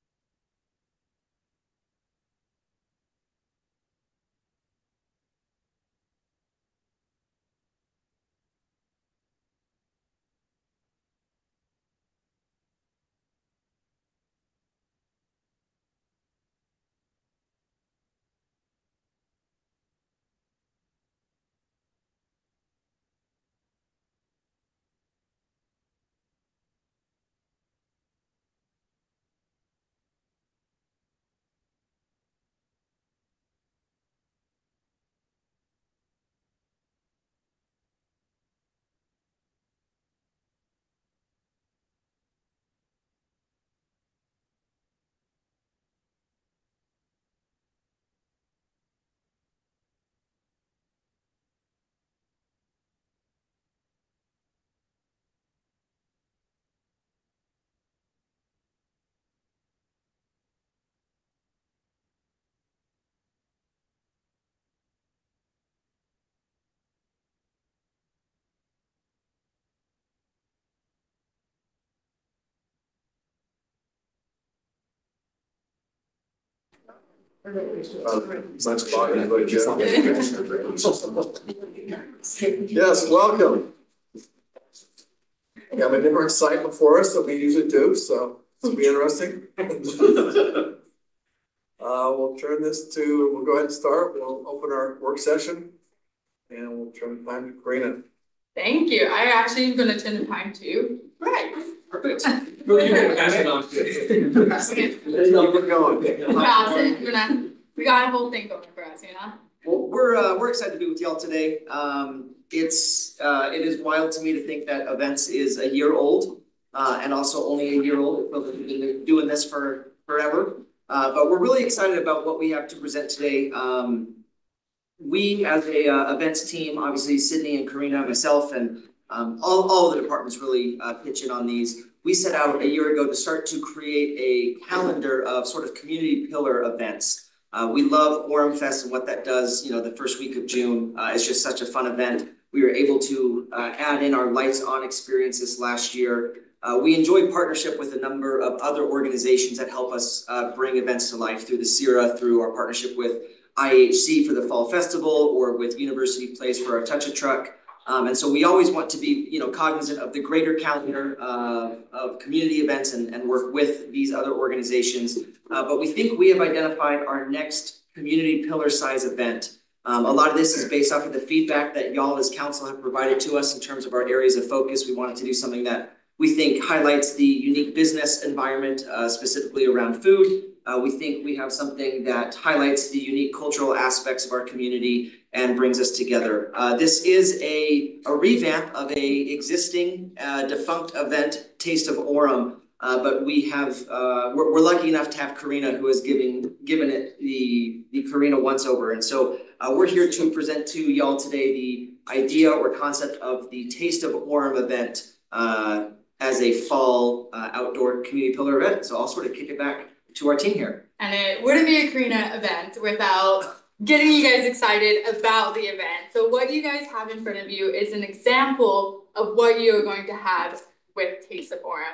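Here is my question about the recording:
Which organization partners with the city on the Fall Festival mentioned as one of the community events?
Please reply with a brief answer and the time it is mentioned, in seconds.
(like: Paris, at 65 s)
IHC, at 153 s.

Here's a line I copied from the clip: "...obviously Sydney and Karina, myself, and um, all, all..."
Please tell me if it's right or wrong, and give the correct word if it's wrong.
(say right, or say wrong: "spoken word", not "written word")
right.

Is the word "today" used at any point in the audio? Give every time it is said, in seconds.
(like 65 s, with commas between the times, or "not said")
111 s, 123 s, 201 s.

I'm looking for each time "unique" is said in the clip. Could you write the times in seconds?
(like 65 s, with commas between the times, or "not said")
177 s, 182 s.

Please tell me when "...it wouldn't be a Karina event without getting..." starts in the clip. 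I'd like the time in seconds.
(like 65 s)
211 s.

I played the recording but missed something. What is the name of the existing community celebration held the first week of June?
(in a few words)
Orem Fest.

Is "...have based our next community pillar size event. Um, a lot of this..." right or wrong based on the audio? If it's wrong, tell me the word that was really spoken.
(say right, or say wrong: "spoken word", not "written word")
wrong: "identified", not "based".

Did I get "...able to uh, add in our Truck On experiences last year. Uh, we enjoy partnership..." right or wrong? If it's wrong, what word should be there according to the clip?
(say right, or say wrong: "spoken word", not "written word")
wrong: "Lights", not "Truck".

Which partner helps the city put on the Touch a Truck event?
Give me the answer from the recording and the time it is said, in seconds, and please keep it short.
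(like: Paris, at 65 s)
University Place, at 155 s.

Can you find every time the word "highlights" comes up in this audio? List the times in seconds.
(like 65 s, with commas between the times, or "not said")
176 s, 182 s.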